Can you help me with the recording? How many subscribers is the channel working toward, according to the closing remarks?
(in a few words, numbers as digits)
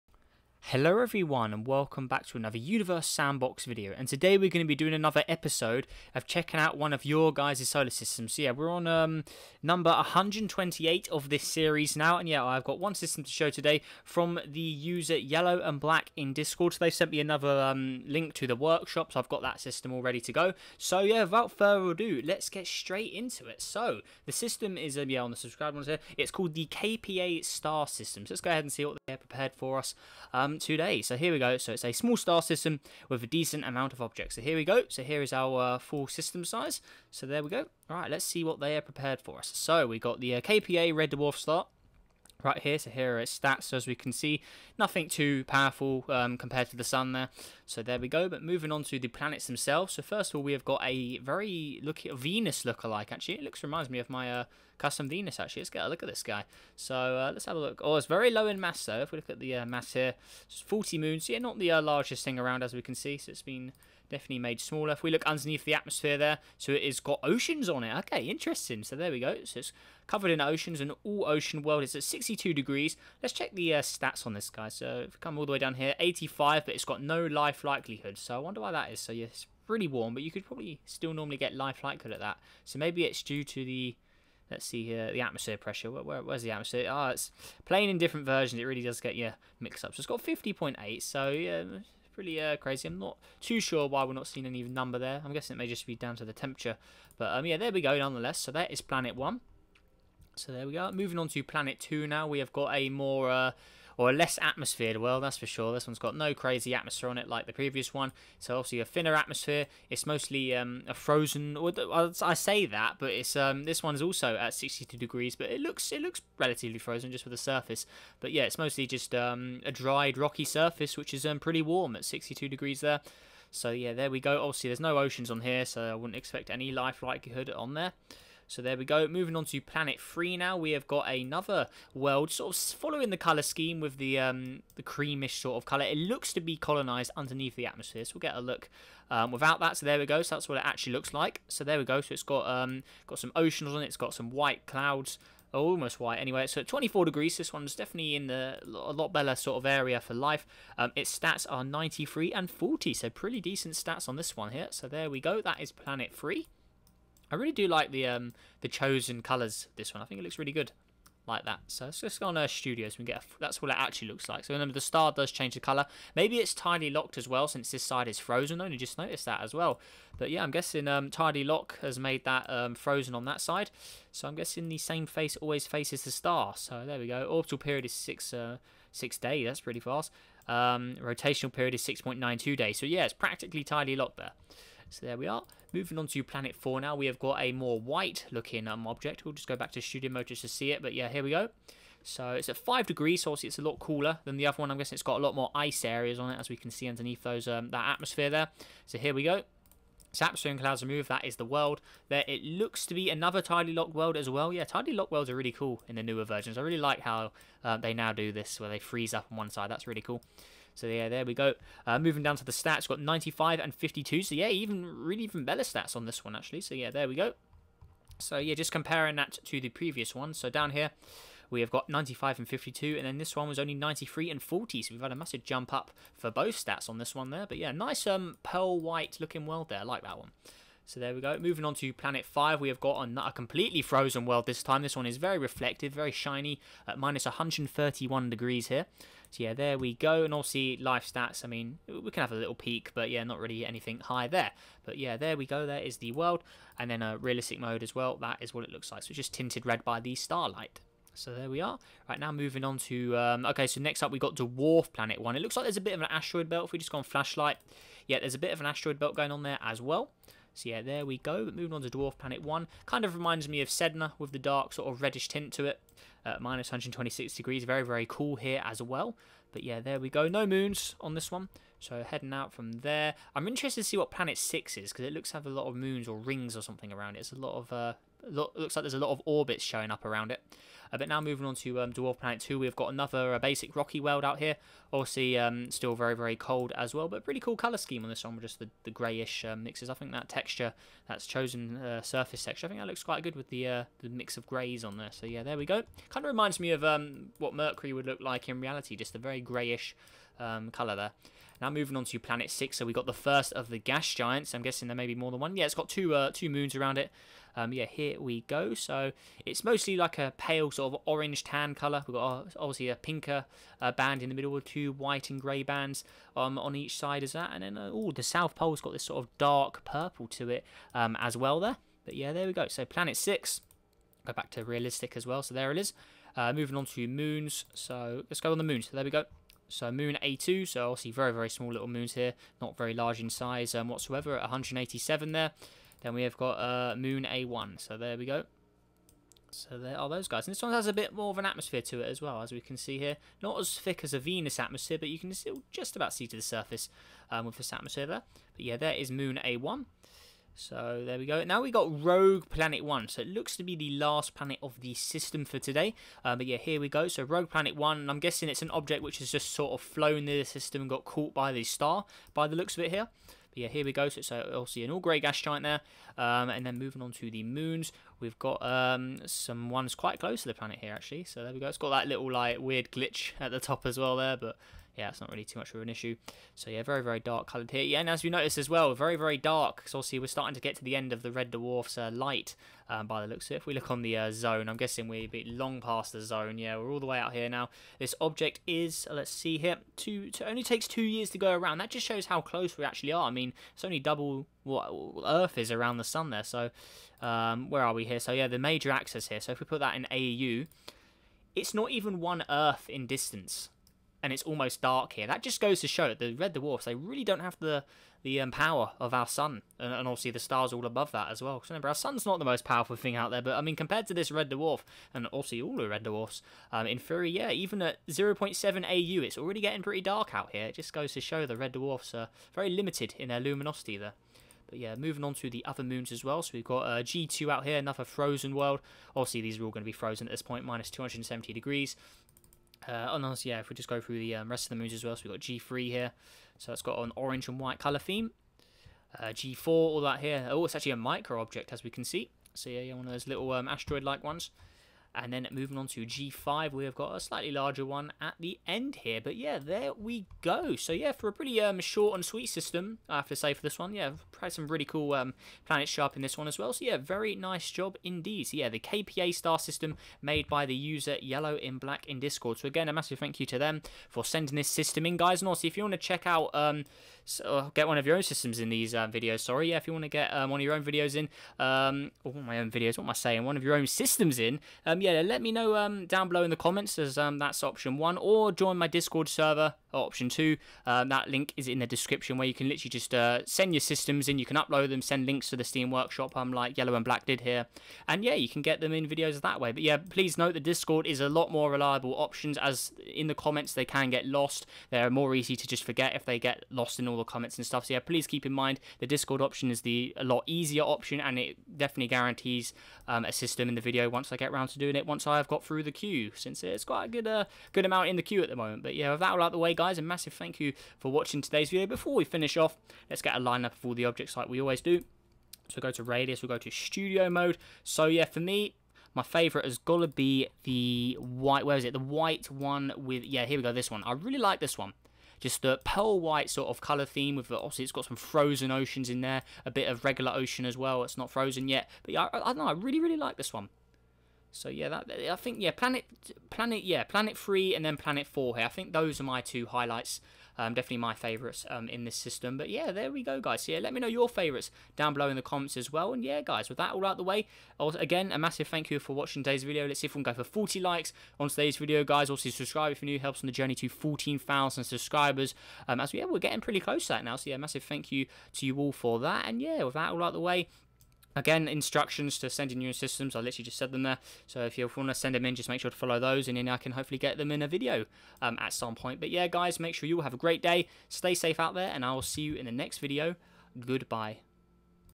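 14,000.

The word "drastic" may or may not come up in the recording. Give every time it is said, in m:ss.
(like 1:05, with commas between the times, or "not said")
not said.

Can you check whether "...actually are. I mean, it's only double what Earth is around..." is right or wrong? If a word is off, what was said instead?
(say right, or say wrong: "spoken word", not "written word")
right.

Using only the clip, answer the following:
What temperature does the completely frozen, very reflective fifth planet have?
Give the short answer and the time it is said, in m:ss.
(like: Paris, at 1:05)
-131 degrees, at 3:56.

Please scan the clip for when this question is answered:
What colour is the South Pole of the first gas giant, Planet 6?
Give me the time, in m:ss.
5:19.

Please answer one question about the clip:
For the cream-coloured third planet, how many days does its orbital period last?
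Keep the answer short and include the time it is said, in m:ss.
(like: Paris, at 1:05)
6 days, at 2:57.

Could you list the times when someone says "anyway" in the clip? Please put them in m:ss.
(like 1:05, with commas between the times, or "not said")
2:26.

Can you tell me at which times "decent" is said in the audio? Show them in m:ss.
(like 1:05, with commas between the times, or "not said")
0:33, 2:33.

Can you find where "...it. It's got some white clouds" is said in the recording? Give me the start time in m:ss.
2:23.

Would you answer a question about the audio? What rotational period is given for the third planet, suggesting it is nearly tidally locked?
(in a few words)
6.92 days.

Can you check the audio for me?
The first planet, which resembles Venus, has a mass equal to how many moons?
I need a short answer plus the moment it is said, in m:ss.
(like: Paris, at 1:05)
40, at 1:00.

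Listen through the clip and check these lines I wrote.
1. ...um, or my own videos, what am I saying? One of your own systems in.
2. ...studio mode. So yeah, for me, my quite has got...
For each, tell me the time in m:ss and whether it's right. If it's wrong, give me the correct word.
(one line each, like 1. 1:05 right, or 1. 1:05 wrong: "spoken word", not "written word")
1. 7:51 right
2. 8:36 wrong: "favourite", not "quite".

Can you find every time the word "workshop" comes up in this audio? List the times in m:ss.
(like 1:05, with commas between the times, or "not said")
0:18, 8:05.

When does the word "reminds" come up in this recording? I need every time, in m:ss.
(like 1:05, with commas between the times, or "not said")
0:53, 4:23, 4:56.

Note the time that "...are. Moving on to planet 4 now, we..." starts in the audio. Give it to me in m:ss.
3:05.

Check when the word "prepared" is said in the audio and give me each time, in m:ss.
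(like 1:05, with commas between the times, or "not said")
0:29, 0:38.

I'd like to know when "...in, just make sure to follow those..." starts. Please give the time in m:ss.
9:25.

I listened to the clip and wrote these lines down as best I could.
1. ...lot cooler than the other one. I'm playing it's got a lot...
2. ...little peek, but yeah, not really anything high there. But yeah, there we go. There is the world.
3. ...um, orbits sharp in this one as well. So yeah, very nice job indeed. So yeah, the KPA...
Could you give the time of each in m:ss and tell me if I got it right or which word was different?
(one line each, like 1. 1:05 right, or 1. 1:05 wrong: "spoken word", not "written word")
1. 3:13 wrong: "guessing", not "playing"
2. 4:02 right
3. 7:35 wrong: "planets", not "orbits".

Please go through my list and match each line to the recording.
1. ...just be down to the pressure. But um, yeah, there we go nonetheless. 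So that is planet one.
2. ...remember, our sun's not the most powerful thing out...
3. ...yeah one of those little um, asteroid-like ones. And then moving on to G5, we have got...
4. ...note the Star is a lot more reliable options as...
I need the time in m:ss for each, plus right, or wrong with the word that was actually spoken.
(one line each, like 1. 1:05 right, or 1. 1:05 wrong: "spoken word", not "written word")
1. 1:35 wrong: "temperature", not "pressure"
2. 6:51 right
3. 7:22 right
4. 8:10 wrong: "Discord", not "Star".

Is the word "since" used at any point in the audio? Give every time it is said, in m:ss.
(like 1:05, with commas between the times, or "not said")
2:47, 8:26.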